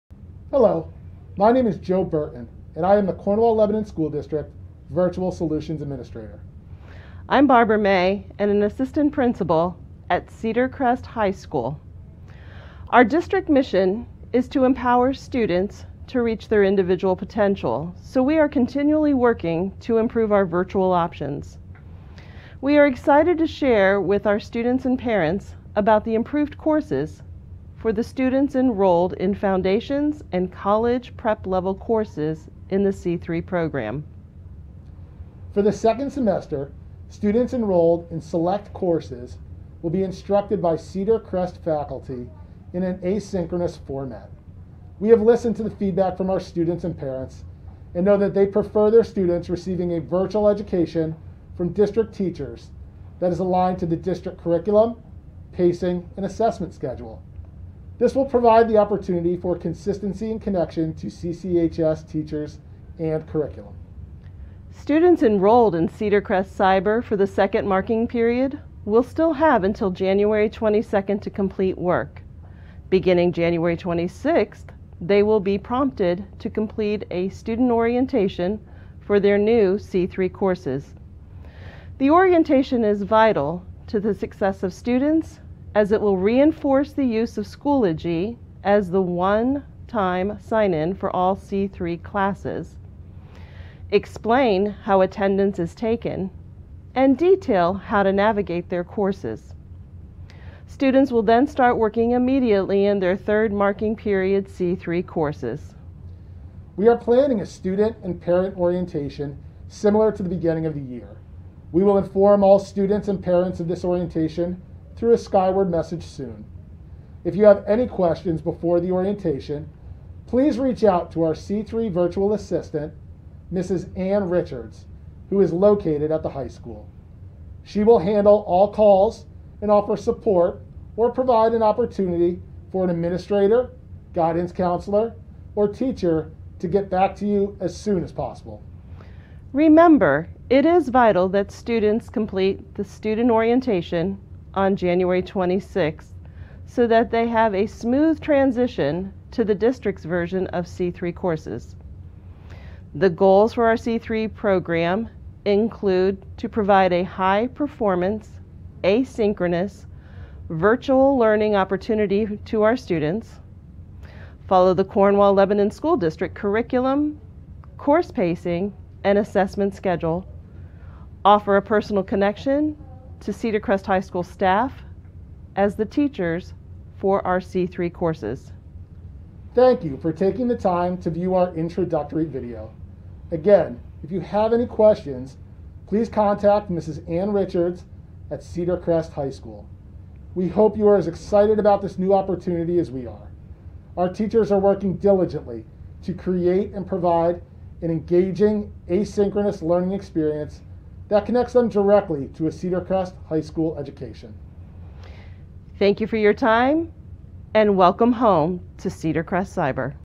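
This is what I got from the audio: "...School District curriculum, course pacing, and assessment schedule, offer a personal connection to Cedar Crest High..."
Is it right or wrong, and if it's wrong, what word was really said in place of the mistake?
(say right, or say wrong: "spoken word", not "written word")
right.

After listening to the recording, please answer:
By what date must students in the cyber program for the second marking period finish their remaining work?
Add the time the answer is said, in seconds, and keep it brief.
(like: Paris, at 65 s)
January 22, at 69 s.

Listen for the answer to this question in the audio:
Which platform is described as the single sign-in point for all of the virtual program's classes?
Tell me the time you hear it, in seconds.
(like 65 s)
87 s.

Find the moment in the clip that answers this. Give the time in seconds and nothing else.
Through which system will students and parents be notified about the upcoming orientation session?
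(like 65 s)
115 s.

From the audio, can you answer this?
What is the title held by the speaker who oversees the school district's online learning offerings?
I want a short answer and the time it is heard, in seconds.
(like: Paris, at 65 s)
Virtual Solutions Administrator, at 4 s.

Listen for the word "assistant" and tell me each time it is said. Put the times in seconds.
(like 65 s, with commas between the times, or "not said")
8 s, 122 s.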